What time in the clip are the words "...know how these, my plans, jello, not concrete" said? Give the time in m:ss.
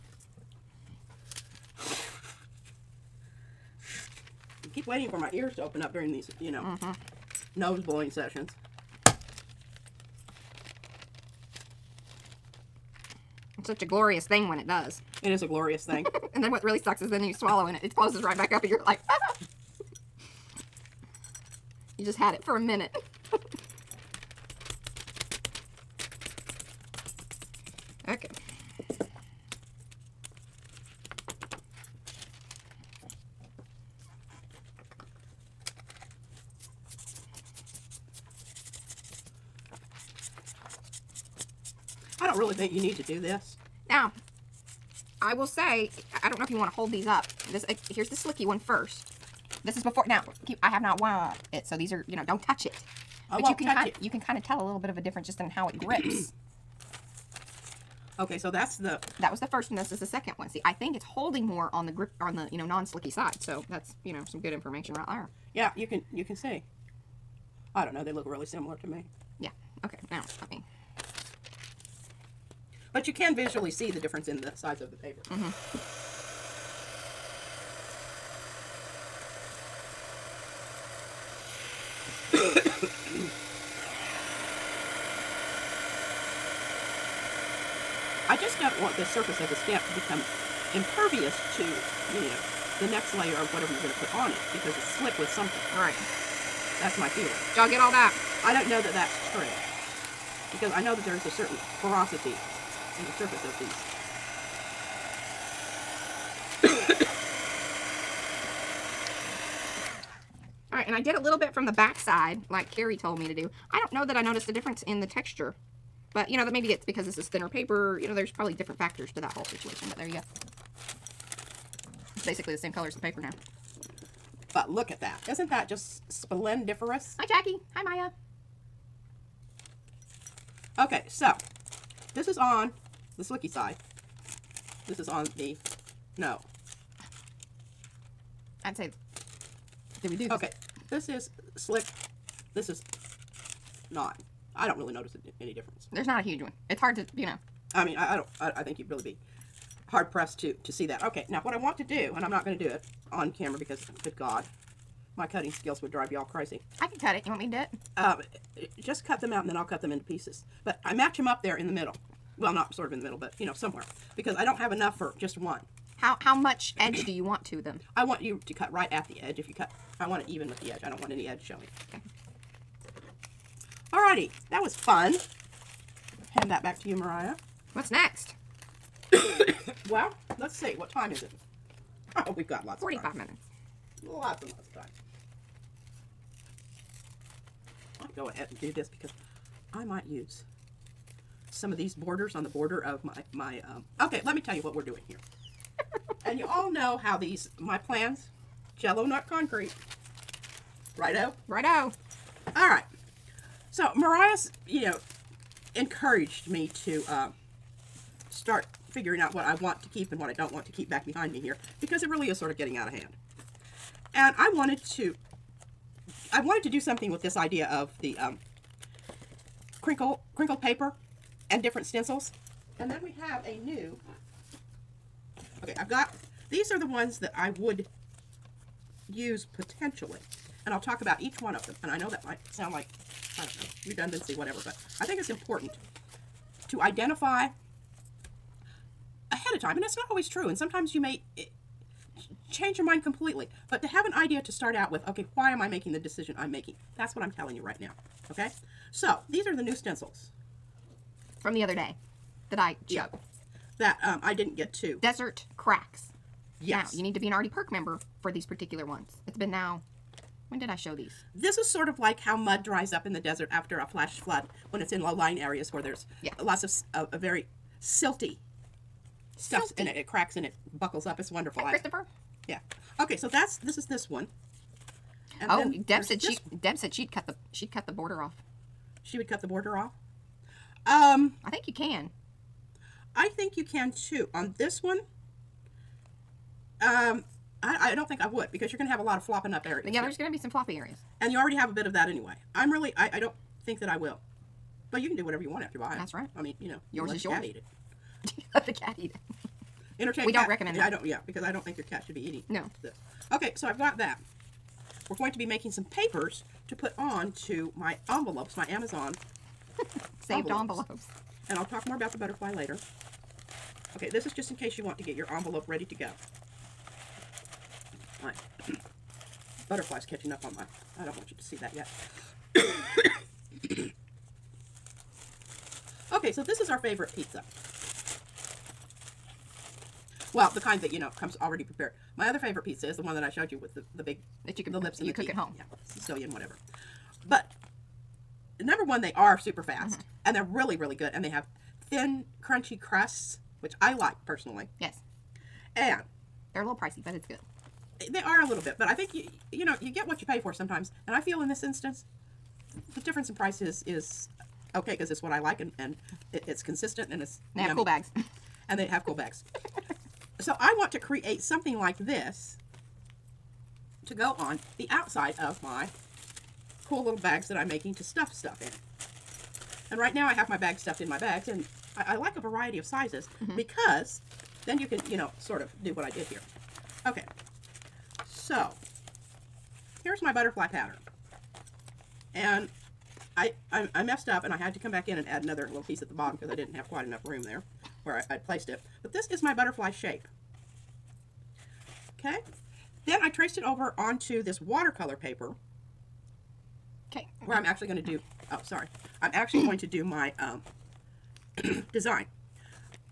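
3:16.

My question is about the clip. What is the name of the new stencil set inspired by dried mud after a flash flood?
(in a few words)
Desert cracks.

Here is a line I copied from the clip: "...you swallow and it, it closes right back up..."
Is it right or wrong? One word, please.
right.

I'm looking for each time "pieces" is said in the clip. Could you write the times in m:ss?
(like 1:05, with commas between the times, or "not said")
2:40, 6:25.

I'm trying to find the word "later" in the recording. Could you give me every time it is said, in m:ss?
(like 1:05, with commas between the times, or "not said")
5:12.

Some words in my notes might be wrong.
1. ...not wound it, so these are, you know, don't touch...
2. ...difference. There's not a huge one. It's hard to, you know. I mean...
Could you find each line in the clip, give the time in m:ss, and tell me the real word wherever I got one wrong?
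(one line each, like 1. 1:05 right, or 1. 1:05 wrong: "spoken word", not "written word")
1. 0:50 right
2. 2:25 right.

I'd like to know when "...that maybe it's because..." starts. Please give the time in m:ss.
1:56.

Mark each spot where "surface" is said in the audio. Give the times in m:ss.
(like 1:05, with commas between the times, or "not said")
1:29, 1:43.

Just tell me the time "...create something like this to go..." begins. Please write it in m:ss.
6:00.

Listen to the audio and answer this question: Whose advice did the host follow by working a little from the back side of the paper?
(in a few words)
Carrie.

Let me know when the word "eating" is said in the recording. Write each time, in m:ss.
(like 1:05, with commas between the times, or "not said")
5:02.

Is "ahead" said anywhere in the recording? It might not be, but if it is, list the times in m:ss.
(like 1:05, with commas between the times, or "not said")
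3:08, 3:59.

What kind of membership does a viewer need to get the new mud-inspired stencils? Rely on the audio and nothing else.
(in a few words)
Artie Perk.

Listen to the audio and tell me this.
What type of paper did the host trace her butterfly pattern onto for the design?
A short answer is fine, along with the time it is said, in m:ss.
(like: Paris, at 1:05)
watercolor paper, at 6:34.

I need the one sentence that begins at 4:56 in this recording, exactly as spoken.
I mean, you know, yours you is yours.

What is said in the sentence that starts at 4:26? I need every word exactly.
lots of a very silty stuff and it.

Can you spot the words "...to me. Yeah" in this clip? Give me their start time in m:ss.
1:08.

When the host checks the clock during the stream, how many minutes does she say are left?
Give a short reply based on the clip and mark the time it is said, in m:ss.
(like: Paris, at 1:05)
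45, at 3:02.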